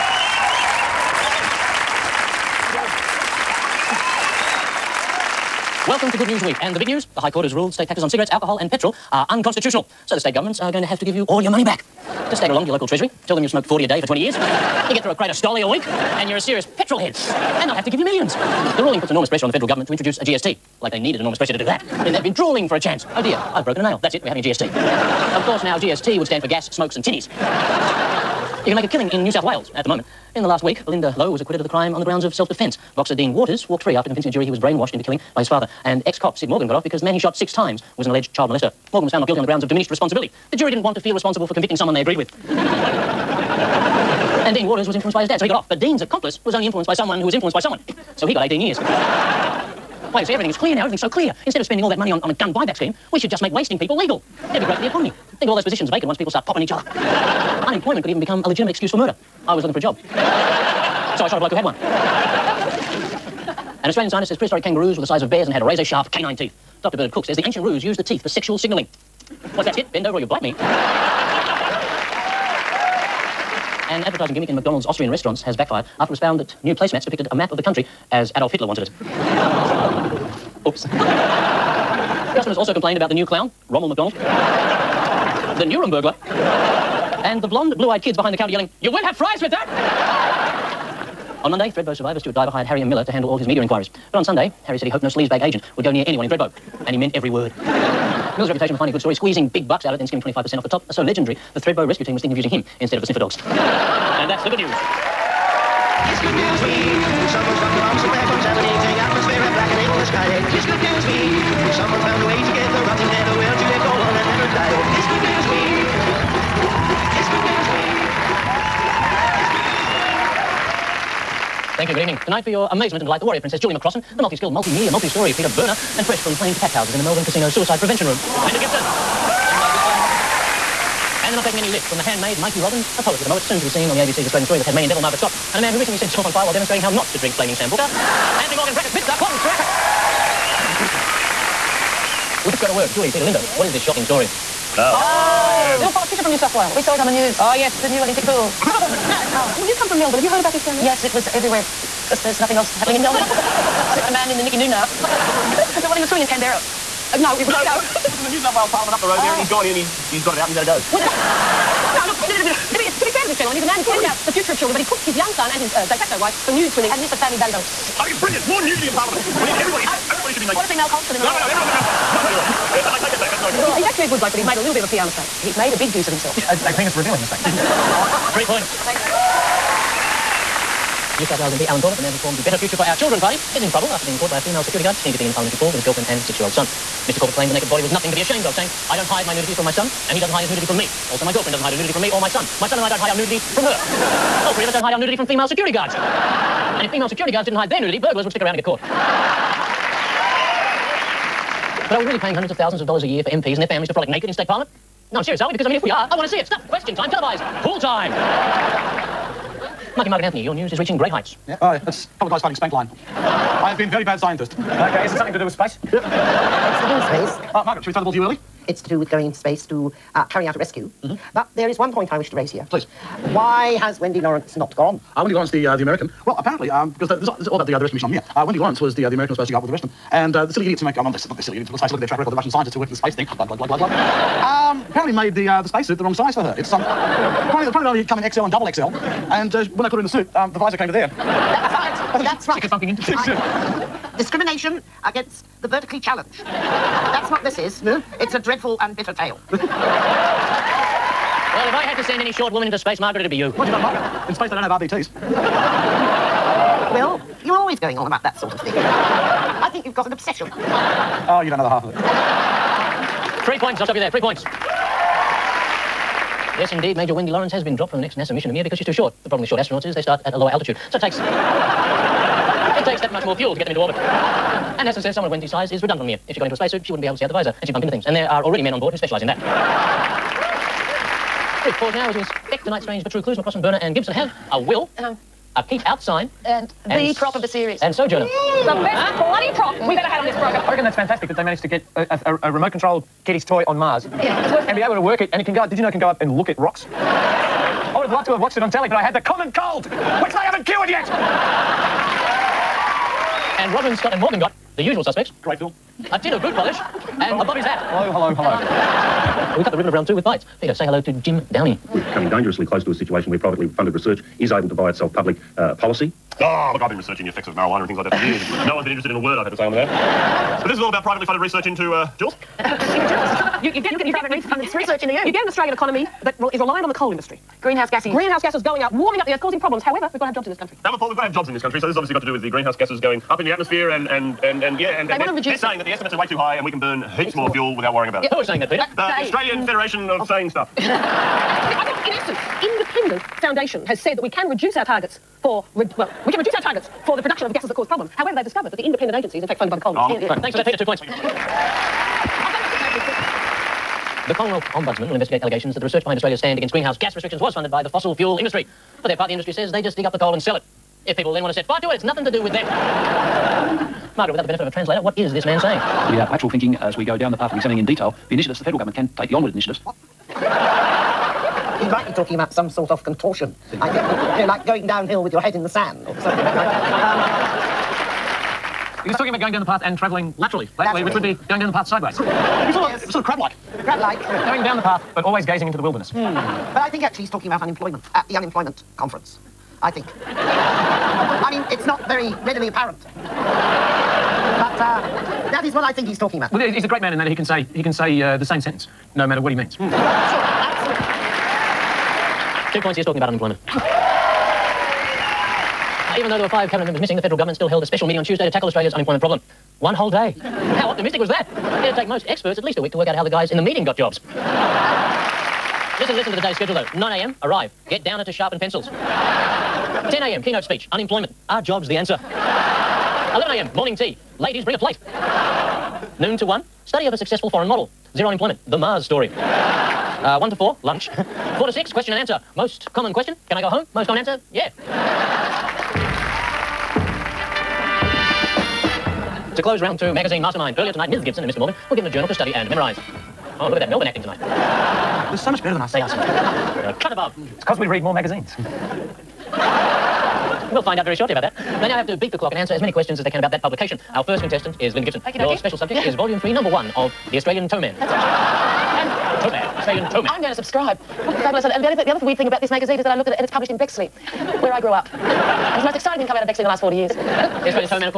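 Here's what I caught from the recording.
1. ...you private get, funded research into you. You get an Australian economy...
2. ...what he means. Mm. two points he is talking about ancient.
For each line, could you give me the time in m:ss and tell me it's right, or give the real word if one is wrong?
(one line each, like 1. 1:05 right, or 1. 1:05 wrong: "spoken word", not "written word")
1. 5:24 right
2. 6:39 wrong: "unemployment", not "ancient".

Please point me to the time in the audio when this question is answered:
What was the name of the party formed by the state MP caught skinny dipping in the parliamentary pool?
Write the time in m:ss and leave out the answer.
3:02.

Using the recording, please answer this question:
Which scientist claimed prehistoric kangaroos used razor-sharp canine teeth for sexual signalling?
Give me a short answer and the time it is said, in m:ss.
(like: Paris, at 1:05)
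Dr. Bernard Cook, at 1:06.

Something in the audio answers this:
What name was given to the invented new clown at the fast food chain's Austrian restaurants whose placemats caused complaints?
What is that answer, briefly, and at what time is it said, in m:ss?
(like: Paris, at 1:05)
Rommel McDonald, at 1:23.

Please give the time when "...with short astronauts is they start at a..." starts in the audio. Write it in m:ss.
4:29.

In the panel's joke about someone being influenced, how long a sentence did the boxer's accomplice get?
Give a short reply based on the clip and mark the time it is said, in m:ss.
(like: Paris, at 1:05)
18 years, at 0:48.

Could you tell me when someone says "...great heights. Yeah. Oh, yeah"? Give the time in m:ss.
3:30.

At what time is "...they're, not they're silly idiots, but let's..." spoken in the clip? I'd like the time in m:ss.
3:51.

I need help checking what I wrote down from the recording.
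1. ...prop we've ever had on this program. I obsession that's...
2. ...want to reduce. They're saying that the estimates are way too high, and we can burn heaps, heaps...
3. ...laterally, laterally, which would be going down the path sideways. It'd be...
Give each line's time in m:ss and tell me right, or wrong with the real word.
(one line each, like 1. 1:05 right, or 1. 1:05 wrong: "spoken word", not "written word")
1. 4:49 wrong: "reckon", not "obsession"
2. 5:35 right
3. 6:20 right.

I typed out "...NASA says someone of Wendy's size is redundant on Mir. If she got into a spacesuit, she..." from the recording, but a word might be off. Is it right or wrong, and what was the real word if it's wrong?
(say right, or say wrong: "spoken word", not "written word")
right.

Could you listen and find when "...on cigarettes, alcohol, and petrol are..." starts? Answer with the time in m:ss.
0:08.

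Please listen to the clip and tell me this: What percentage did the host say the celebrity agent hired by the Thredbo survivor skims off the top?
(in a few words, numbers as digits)
25%.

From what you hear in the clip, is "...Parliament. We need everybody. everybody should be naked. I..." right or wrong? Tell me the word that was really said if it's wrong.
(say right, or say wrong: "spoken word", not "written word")
right.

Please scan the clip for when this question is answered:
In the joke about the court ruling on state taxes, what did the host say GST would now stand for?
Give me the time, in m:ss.
0:26.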